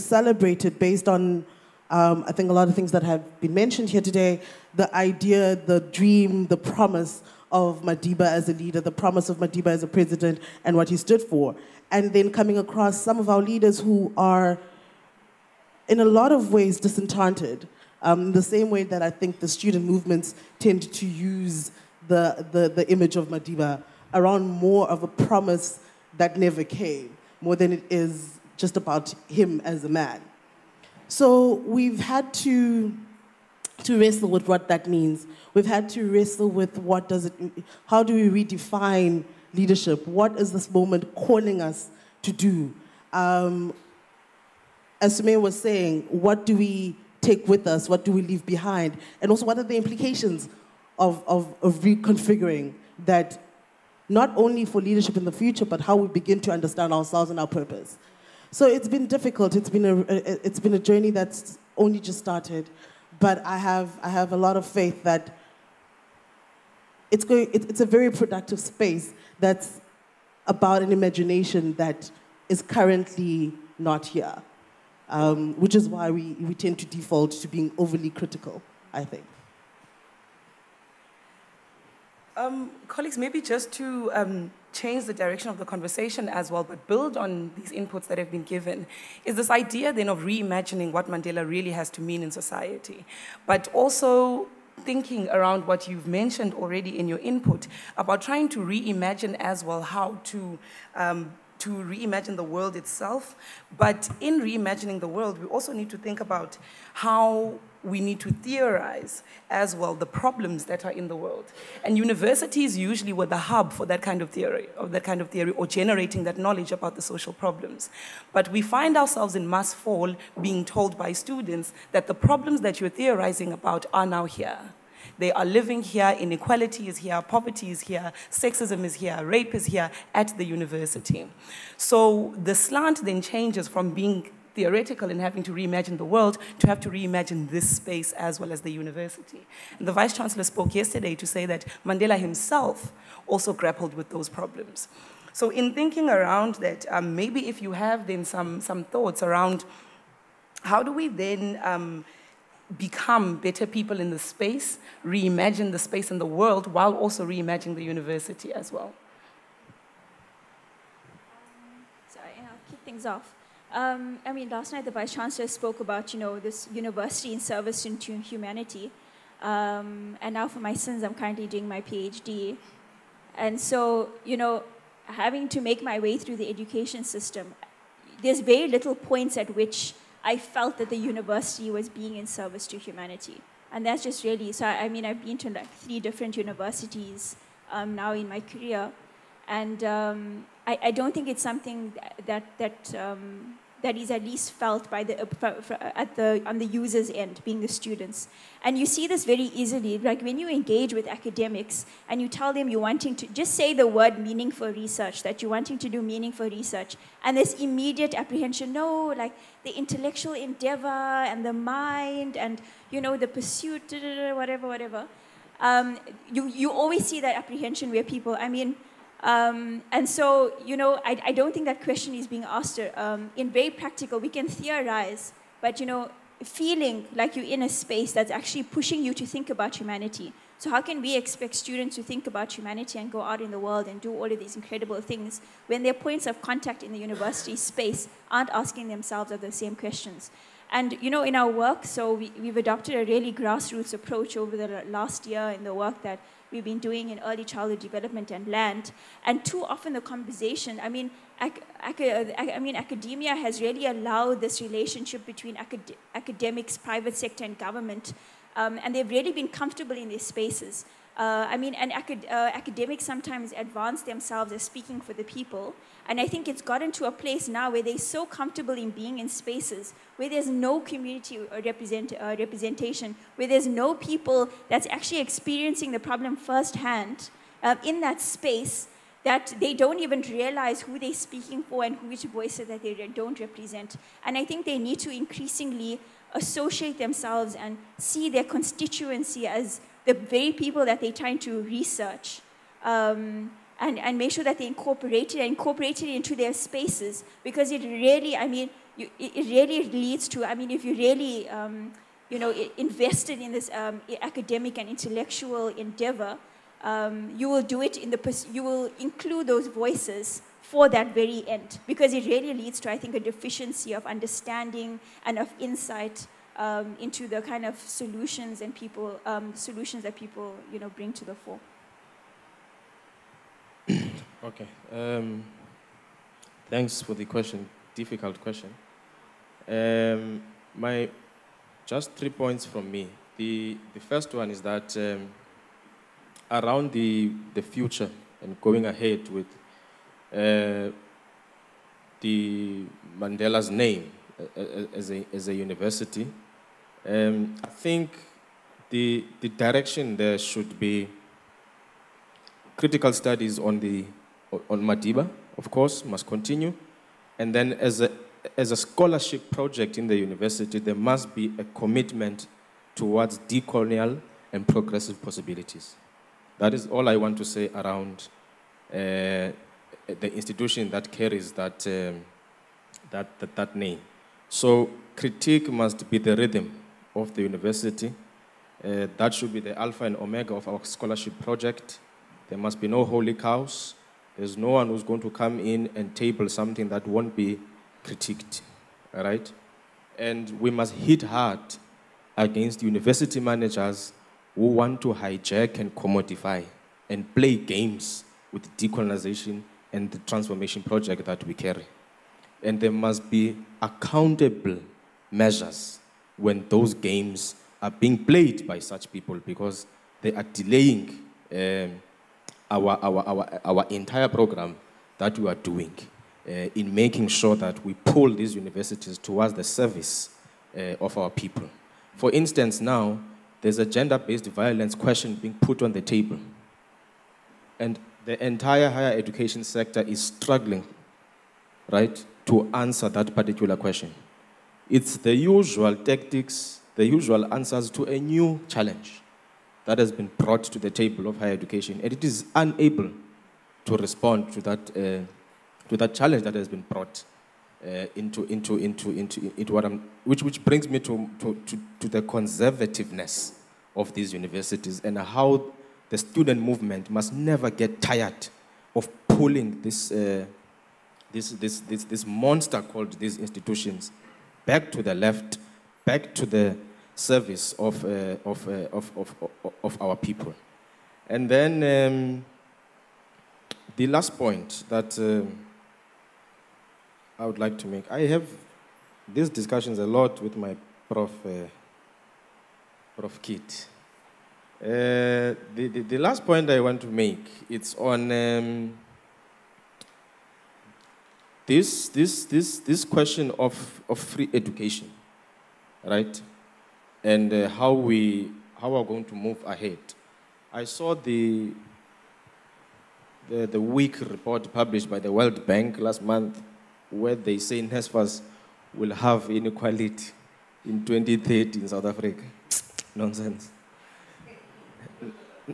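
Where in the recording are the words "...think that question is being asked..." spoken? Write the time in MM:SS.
03:41.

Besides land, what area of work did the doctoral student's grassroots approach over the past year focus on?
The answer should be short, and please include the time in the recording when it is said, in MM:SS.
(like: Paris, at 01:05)
early childhood development, at 04:07.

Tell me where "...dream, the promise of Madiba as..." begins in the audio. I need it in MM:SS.
00:05.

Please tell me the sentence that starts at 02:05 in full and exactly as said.
They are living here, inequality is here, poverty is here, sexism is here, rape is here at the university.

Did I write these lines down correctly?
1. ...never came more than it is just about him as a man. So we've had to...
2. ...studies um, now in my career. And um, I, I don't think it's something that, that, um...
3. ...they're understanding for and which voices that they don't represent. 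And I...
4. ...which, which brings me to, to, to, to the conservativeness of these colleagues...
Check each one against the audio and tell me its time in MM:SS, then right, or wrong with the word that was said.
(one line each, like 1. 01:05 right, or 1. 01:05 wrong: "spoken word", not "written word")
1. 00:26 right
2. 03:06 wrong: "universities", not "studies"
3. 04:40 wrong: "speaking", not "understanding"
4. 07:30 wrong: "universities", not "colleagues".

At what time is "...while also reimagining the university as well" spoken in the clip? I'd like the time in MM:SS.
02:36.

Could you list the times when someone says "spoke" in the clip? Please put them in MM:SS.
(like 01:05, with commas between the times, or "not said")
02:20, 02:45.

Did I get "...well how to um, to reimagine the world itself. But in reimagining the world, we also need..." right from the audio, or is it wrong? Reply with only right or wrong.
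right.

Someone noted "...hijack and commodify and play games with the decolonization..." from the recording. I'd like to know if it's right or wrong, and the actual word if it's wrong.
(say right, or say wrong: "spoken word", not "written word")
right.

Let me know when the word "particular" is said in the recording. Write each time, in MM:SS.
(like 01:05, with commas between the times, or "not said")
07:13.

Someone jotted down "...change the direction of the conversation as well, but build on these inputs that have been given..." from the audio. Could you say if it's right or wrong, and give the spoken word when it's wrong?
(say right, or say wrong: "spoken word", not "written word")
right.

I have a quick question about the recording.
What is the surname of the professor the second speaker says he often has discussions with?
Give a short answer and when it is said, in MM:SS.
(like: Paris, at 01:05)
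Keet, at 08:03.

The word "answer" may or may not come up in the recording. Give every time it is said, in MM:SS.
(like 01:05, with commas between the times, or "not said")
07:12, 07:17.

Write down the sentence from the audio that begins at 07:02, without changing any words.
For instance, now, there's a gender-based violence question being put on the table.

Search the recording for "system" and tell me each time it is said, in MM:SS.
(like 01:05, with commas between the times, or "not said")
02:57.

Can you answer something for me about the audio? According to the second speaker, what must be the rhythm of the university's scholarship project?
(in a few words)
critique.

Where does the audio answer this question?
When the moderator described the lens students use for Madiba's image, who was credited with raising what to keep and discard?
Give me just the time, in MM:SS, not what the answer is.
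00:45.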